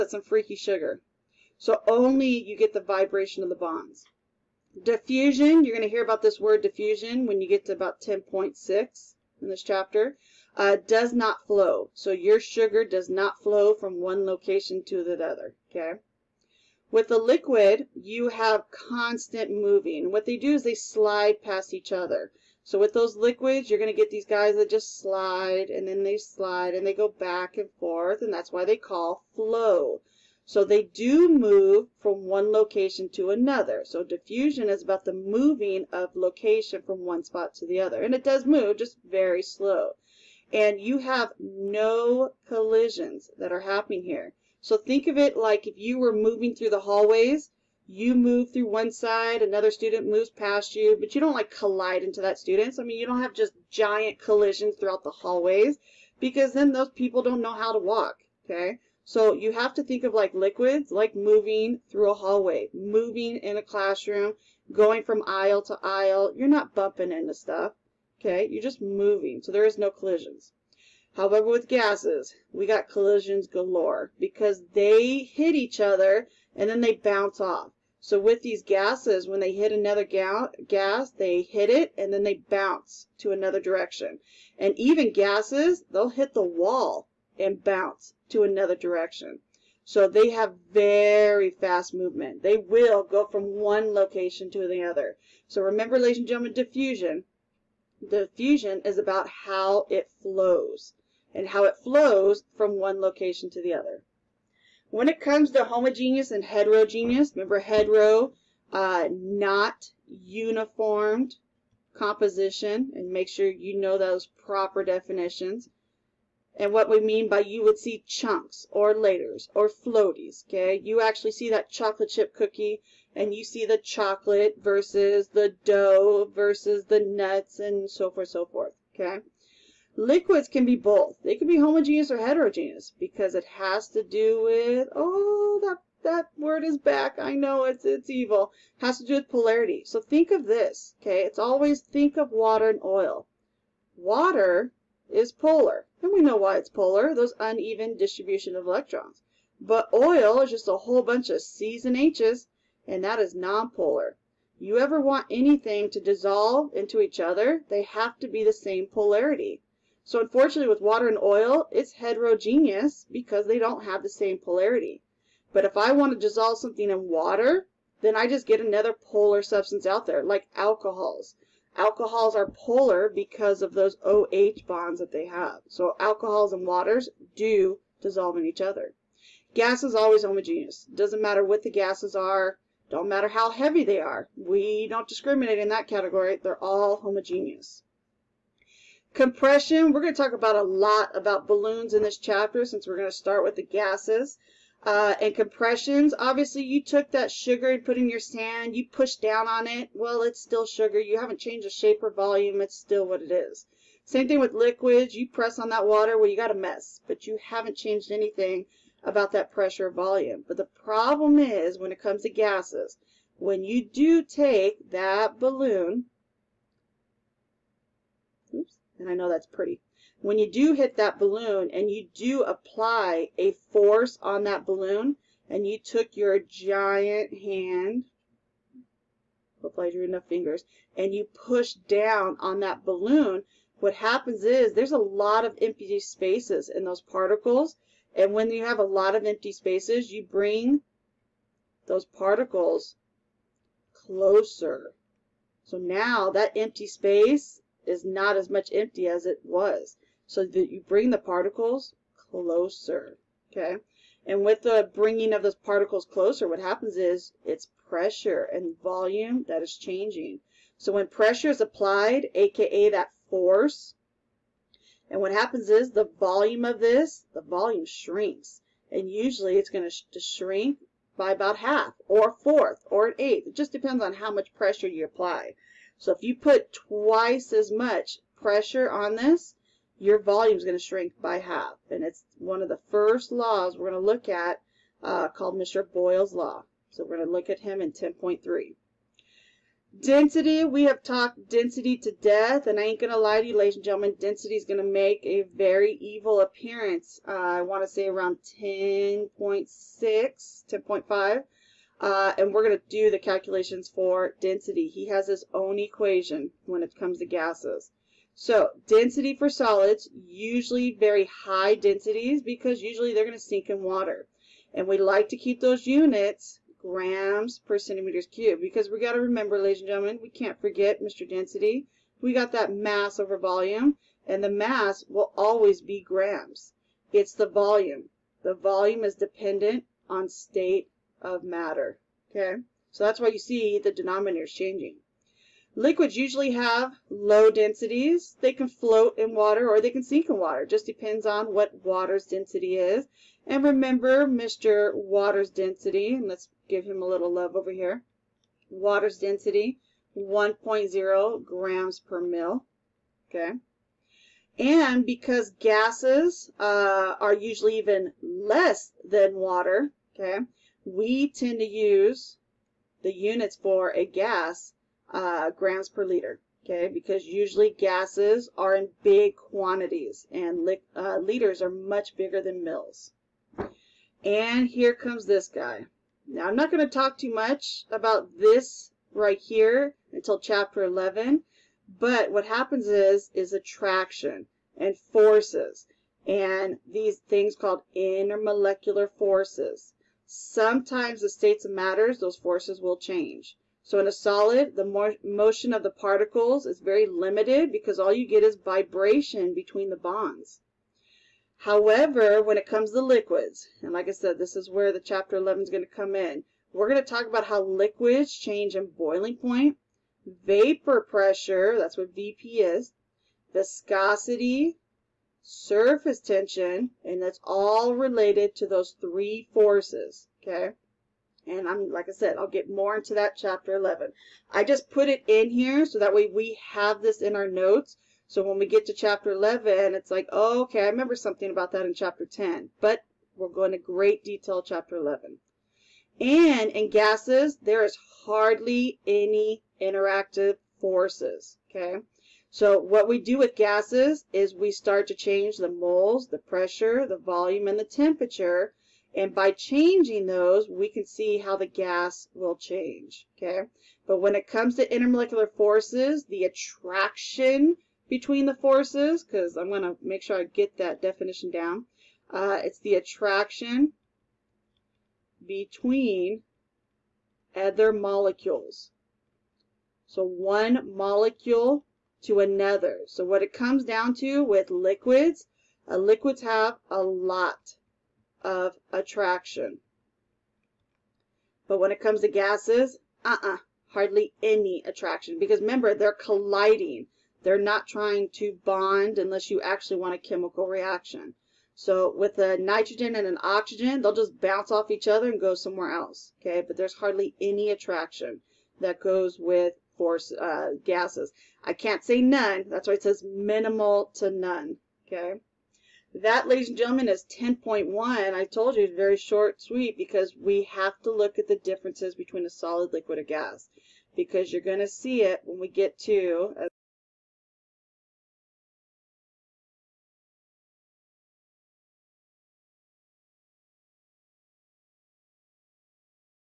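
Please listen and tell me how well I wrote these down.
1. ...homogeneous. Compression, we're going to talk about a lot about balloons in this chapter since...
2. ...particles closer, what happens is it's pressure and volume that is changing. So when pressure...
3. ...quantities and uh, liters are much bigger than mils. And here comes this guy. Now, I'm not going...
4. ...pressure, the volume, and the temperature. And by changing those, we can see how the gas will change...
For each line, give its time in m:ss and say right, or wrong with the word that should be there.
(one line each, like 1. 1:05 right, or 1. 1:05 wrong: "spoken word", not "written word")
1. 3:06 right
2. 4:15 right
3. 6:09 right
4. 7:26 right.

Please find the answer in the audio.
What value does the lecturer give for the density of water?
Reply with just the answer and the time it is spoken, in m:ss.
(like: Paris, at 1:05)
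1.0 grams per mL, at 5:50.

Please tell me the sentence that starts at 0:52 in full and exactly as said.
So, I mean, you don't have just giant collisions throughout the hallways because then those people don't know how to walk, okay?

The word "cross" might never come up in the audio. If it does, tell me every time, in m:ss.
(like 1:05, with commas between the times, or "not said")
not said.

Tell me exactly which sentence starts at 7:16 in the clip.
And in gases, there is hardly any interactive forces, okay?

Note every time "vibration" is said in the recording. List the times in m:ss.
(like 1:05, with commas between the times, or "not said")
0:02, 6:38.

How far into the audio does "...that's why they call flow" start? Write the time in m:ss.
0:28.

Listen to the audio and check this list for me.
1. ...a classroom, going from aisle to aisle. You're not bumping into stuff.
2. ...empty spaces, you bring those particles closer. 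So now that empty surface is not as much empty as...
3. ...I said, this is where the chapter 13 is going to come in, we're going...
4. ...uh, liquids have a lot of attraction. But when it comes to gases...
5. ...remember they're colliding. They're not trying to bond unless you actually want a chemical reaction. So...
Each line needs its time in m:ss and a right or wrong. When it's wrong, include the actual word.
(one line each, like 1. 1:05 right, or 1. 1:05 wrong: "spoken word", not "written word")
1. 1:03 right
2. 3:59 wrong: "space", not "surface"
3. 6:44 wrong: "11", not "13"
4. 7:55 right
5. 8:05 right.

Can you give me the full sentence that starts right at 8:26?
That, ladies and gentlemen, is 10.1.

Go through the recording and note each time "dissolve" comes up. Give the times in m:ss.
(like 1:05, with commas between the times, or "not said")
2:35, 2:46, 2:57.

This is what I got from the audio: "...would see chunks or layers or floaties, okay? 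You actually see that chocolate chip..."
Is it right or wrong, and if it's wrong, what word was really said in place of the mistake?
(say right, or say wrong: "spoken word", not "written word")
right.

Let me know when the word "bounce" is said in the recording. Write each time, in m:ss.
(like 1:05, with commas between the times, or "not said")
1:16, 1:22, 1:27, 8:14.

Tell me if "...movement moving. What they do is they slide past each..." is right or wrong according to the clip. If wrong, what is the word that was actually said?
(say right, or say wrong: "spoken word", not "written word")
wrong: "constant", not "movement".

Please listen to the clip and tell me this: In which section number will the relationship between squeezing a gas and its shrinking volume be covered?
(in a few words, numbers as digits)
10.3.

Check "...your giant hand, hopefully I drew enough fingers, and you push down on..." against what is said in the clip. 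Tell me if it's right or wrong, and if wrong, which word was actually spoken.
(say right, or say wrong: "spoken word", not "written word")
right.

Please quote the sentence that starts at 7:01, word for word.
And I'm, like I said, I'll get more into that chapter 11.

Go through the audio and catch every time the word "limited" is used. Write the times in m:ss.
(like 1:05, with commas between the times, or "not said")
6:37.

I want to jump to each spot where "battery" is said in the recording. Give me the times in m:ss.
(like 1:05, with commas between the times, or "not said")
not said.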